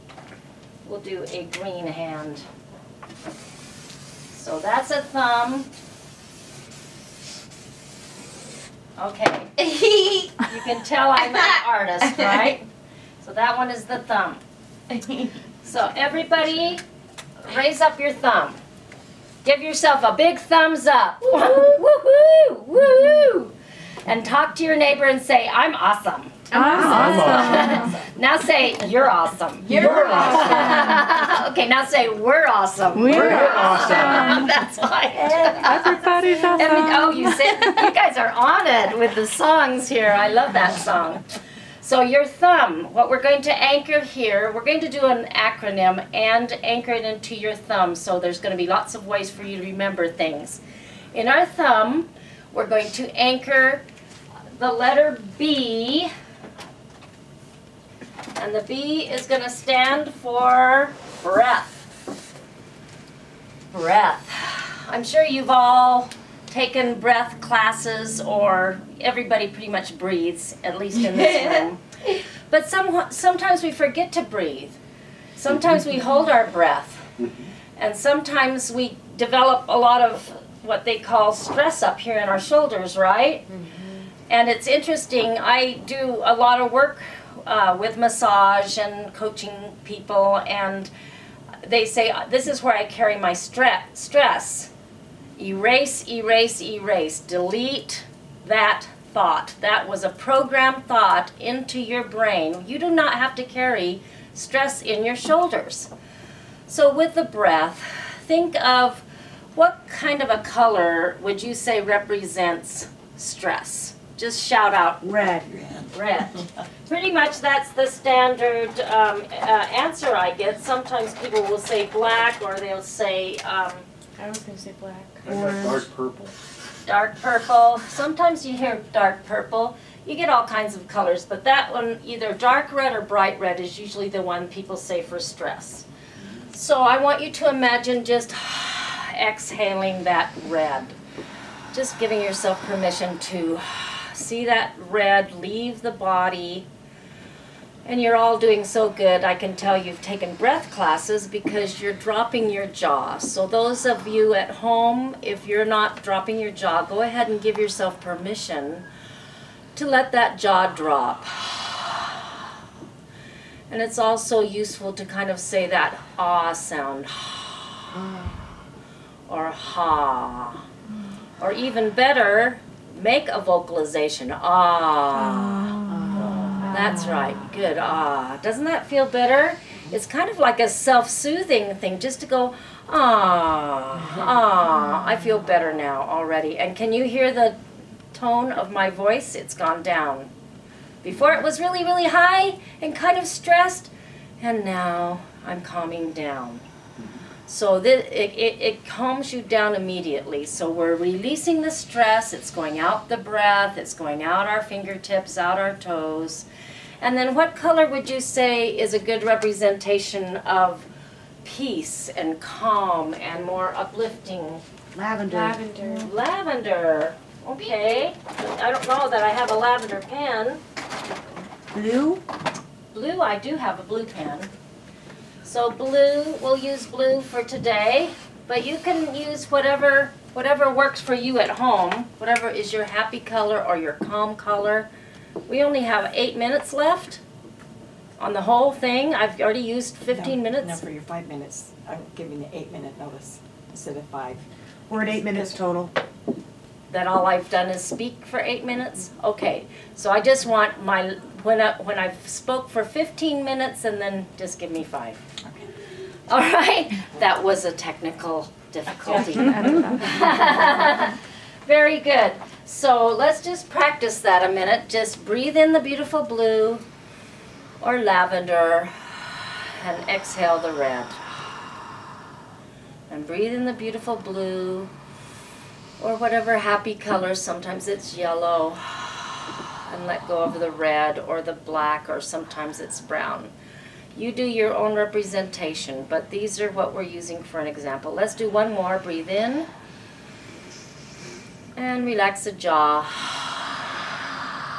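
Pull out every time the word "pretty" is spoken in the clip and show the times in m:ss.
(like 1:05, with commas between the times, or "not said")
1:09, 1:56.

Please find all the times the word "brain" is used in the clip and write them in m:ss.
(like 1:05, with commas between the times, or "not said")
1:42.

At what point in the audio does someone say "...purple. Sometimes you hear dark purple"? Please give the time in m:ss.
2:07.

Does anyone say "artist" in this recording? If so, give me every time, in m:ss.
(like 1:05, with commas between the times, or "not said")
0:11.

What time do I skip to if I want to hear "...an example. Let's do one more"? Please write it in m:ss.
4:47.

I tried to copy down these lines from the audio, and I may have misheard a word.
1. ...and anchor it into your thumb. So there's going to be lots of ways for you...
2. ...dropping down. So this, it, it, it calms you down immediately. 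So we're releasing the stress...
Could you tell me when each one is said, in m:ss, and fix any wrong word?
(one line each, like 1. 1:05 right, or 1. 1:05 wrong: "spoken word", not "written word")
1. 0:46 right
2. 3:15 wrong: "calming", not "dropping".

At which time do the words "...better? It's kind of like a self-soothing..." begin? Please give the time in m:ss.
2:59.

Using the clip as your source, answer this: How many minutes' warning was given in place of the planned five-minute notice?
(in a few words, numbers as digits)
8 minutes.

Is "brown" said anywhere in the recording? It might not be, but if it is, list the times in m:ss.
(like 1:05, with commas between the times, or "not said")
4:43.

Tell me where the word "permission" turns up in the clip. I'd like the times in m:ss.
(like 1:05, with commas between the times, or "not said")
2:22, 2:37.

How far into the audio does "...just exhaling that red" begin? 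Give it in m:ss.
2:18.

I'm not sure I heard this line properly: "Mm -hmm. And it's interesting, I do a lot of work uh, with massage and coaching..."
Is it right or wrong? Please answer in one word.
right.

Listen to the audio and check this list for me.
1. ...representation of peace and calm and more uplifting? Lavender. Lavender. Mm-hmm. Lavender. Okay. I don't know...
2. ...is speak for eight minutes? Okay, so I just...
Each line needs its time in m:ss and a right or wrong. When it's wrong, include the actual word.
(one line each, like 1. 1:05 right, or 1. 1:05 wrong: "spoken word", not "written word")
1. 3:29 right
2. 4:07 right.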